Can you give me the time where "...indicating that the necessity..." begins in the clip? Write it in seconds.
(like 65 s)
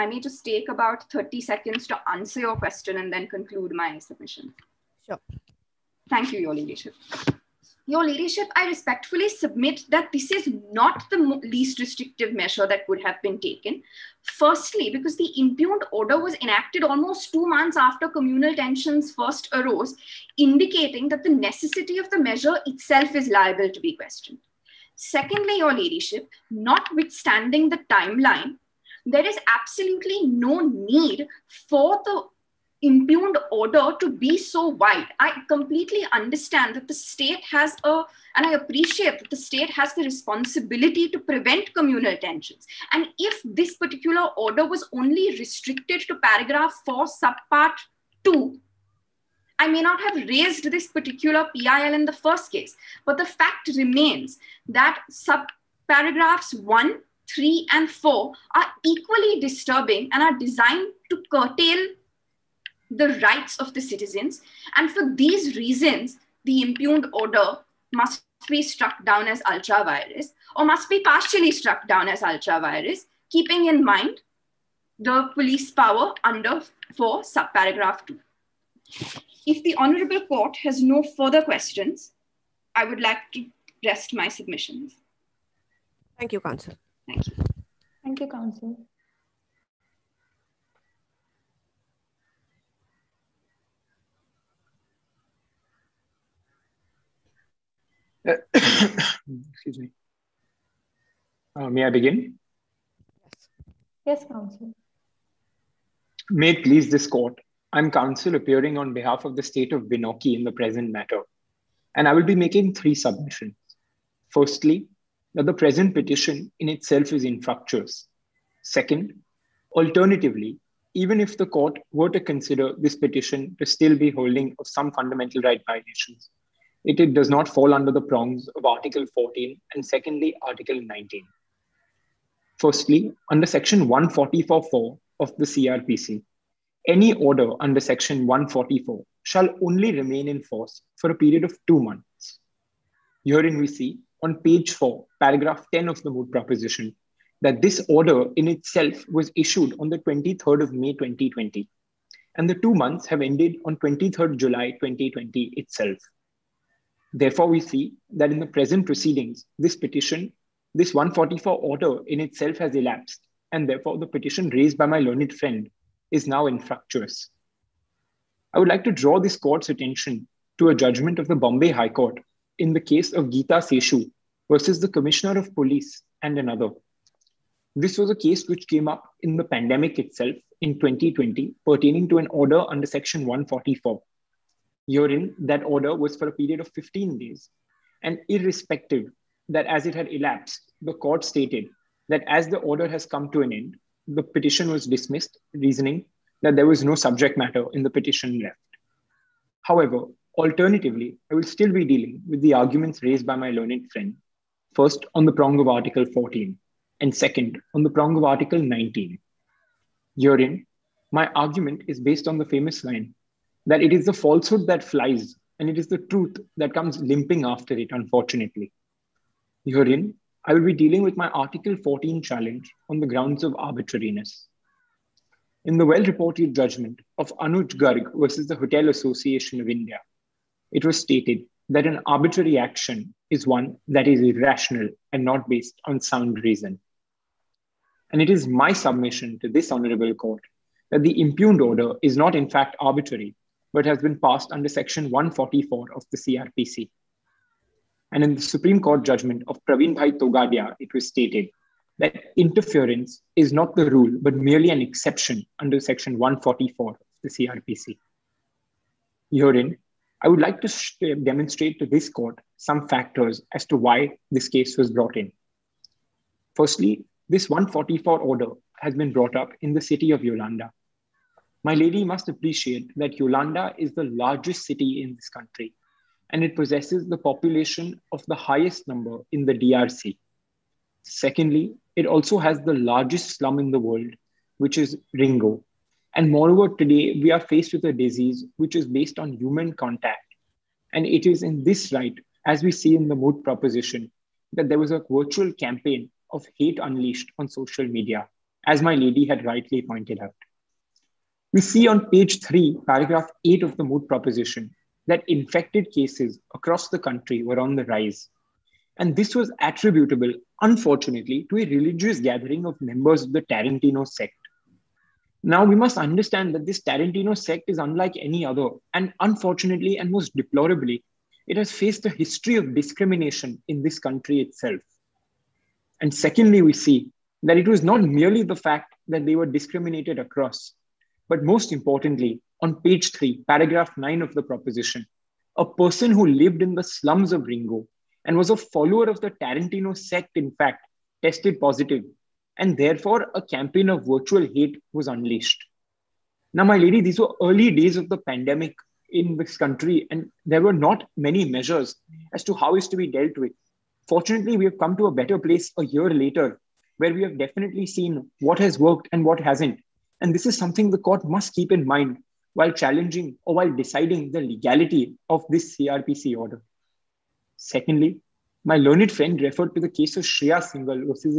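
20 s.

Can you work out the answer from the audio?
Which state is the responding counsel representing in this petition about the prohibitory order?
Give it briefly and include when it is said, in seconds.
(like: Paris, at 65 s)
Binoki, at 109 s.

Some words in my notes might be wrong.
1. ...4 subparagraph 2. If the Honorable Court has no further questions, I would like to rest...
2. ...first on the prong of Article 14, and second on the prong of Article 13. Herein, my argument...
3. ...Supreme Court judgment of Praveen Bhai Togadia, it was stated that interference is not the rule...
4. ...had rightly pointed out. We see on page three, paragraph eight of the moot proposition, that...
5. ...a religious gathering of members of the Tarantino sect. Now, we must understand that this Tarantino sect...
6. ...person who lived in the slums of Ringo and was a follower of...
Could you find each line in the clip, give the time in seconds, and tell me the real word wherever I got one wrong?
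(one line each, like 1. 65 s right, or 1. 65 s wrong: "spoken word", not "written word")
1. 76 s right
2. 204 s wrong: "19", not "13"
3. 248 s right
4. 299 s right
5. 311 s right
6. 335 s right.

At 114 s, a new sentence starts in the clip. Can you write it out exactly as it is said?
Firstly, that the present petition in itself is infructuous.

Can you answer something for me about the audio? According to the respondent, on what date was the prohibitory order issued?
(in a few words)
23 May 2020.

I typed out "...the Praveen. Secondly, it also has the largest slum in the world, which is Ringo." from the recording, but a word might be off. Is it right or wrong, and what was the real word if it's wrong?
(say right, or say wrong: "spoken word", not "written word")
wrong: "DRC", not "Praveen".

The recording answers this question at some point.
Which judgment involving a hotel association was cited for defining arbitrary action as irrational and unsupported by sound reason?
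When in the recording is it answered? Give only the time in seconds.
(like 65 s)
227 s.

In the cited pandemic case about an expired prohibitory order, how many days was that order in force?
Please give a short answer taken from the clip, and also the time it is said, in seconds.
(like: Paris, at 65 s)
15 days, at 186 s.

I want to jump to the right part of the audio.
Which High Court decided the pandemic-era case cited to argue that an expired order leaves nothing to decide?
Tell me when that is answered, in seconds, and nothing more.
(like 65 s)
171 s.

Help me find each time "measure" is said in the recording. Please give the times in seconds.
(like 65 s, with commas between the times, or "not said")
12 s, 22 s, 351 s.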